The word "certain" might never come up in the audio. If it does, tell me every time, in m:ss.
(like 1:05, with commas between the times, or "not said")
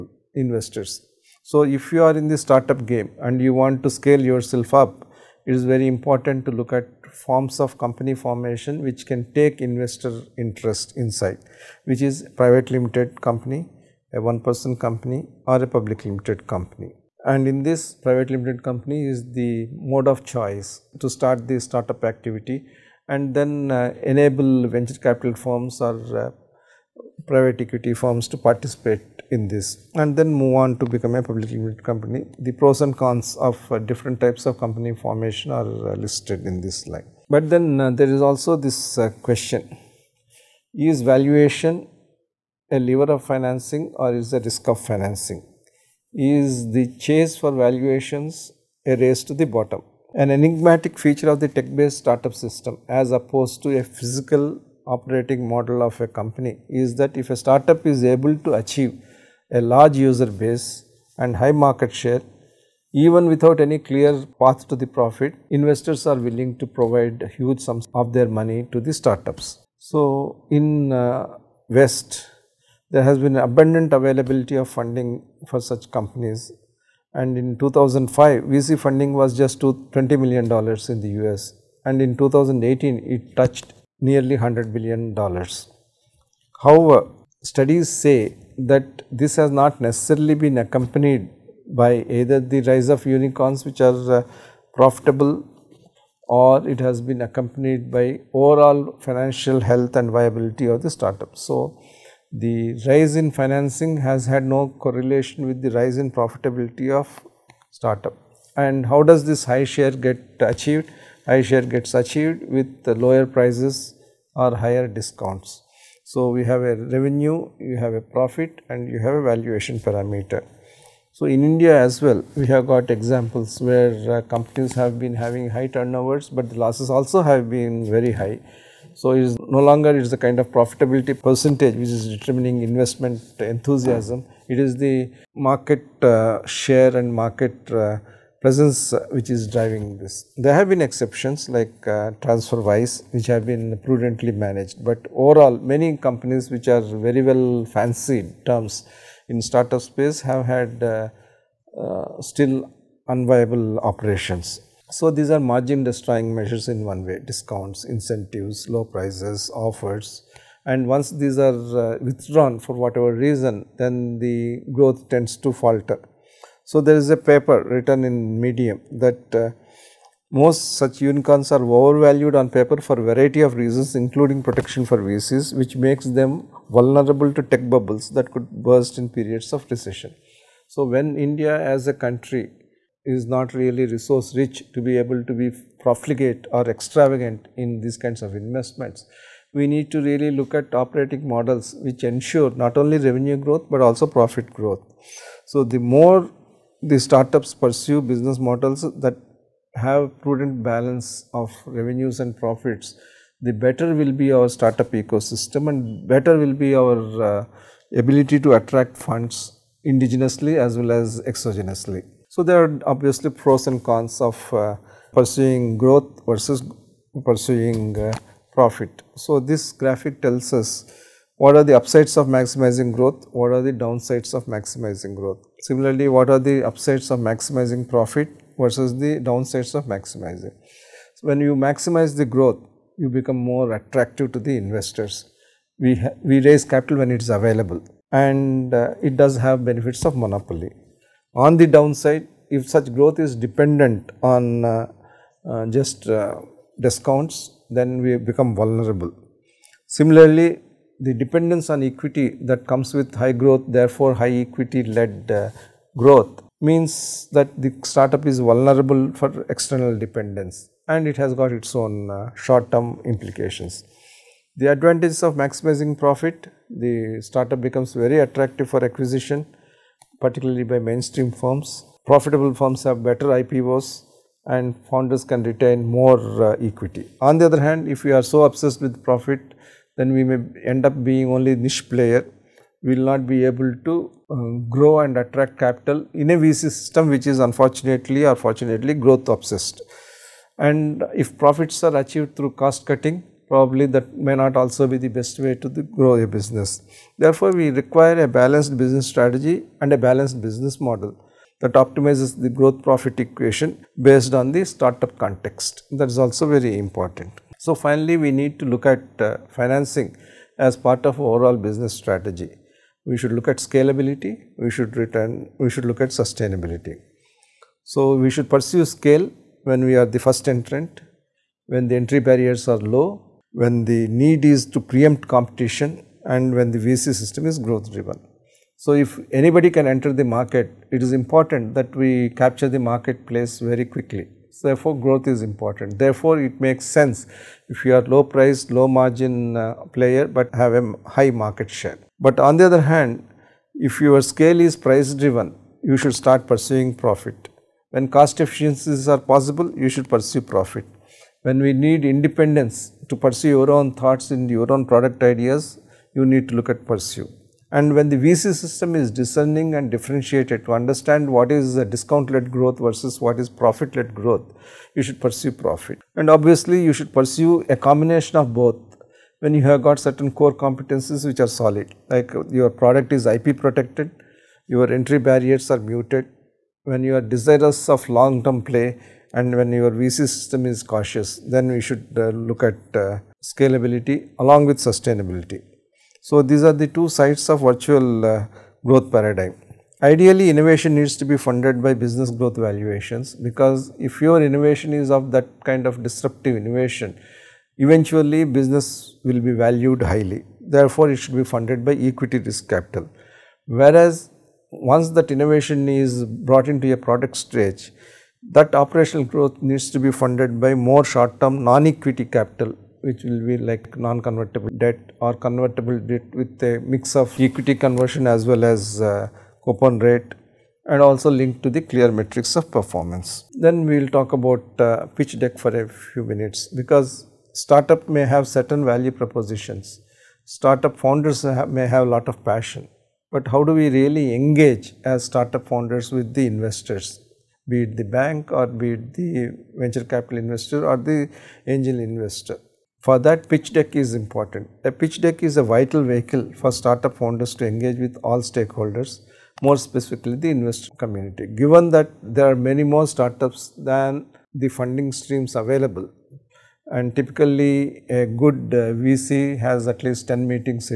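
6:09, 7:08.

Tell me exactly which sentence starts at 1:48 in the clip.
And how does this high share get achieved?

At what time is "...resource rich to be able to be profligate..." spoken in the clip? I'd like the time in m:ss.
3:03.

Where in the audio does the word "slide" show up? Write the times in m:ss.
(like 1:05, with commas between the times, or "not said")
0:36.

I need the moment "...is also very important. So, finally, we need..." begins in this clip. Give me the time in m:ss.
5:06.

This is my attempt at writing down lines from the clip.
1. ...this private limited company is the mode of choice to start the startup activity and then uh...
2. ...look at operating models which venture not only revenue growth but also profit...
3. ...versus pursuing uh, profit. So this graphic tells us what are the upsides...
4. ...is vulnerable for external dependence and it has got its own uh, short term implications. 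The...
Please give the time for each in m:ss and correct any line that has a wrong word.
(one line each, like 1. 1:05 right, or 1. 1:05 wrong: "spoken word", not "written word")
1. 0:17 right
2. 3:10 wrong: "ensure", not "venture"
3. 3:36 right
4. 4:18 right.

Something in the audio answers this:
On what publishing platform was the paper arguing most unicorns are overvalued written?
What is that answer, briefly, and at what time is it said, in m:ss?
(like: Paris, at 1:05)
Medium, at 2:48.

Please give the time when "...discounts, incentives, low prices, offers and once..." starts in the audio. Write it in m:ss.
2:37.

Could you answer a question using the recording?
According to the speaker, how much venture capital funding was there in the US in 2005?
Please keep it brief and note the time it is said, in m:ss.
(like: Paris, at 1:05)
$20 million, at 1:19.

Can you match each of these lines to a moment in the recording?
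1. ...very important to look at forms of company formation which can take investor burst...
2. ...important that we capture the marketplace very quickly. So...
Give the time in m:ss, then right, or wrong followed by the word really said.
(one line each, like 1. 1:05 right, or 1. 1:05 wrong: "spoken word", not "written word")
1. 0:05 wrong: "interest", not "burst"
2. 5:31 right.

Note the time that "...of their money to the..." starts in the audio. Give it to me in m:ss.
1:07.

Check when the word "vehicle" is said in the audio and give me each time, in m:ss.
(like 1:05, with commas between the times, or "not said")
7:26.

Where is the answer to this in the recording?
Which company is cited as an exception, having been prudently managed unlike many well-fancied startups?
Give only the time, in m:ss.
2:22.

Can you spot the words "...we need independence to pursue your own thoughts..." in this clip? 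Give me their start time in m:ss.
5:51.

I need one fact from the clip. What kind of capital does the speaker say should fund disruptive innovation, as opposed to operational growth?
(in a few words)
Equity risk capital.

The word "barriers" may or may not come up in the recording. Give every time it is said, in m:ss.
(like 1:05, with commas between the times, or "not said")
5:22, 6:15.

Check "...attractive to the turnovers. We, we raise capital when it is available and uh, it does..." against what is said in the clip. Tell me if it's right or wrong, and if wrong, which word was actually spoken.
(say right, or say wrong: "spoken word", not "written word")
wrong: "investors", not "turnovers".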